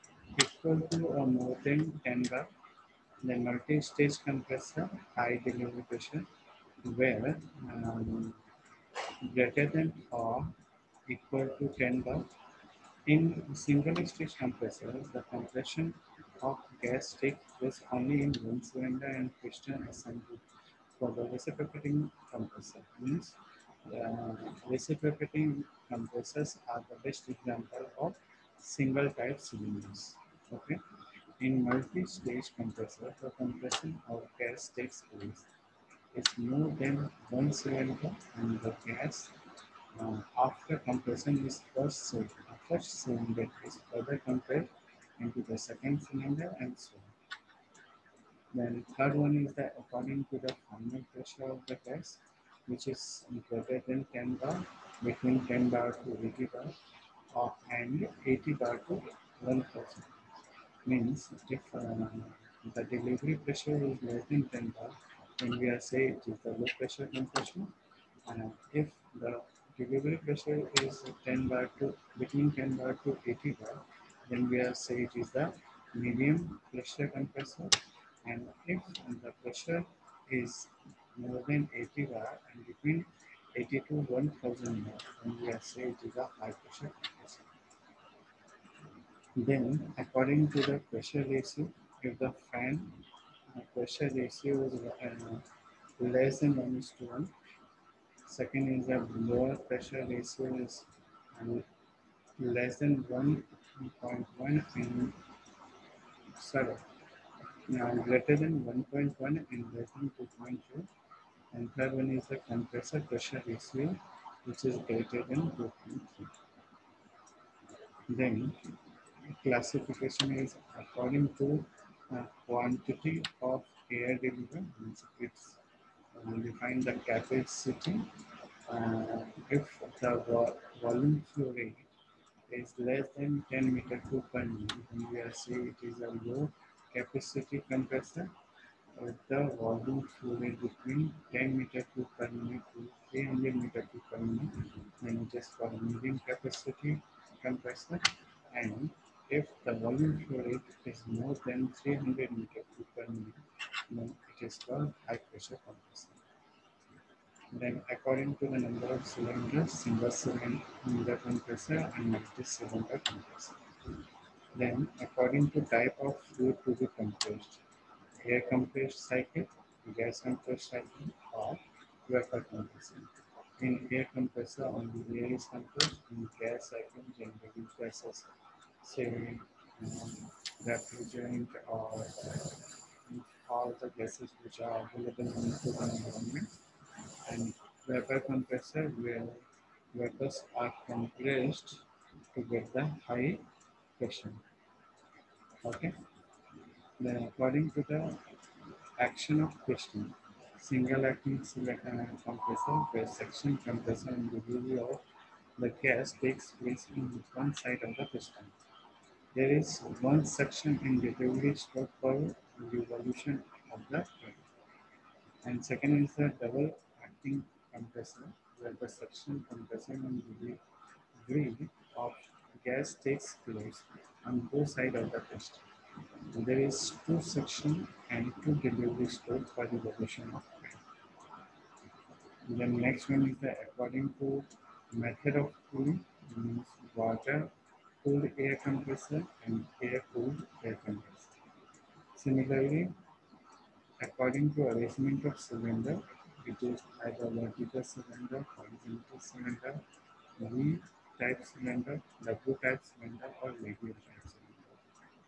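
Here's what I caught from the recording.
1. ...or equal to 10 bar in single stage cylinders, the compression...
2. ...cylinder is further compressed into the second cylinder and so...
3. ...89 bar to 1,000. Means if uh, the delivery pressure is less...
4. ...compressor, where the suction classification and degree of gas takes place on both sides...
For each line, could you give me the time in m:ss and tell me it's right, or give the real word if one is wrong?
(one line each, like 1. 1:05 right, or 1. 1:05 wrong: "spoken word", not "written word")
1. 0:10 wrong: "compressors", not "cylinders"
2. 0:43 right
3. 0:58 wrong: "80", not "89"
4. 3:37 wrong: "compression", not "classification".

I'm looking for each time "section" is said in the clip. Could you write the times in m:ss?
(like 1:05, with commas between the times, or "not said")
3:23, 3:30.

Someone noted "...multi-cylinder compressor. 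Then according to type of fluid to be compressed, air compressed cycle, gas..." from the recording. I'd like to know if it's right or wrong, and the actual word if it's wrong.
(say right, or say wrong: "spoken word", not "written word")
right.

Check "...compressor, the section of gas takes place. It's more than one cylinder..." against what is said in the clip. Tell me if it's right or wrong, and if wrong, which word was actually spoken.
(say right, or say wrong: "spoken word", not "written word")
wrong: "compression", not "section".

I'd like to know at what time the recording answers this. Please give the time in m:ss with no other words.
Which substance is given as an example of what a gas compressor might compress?
3:00.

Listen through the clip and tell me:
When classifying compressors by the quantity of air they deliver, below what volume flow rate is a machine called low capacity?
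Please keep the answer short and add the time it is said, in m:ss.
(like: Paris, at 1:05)
10 meter per minute, at 2:12.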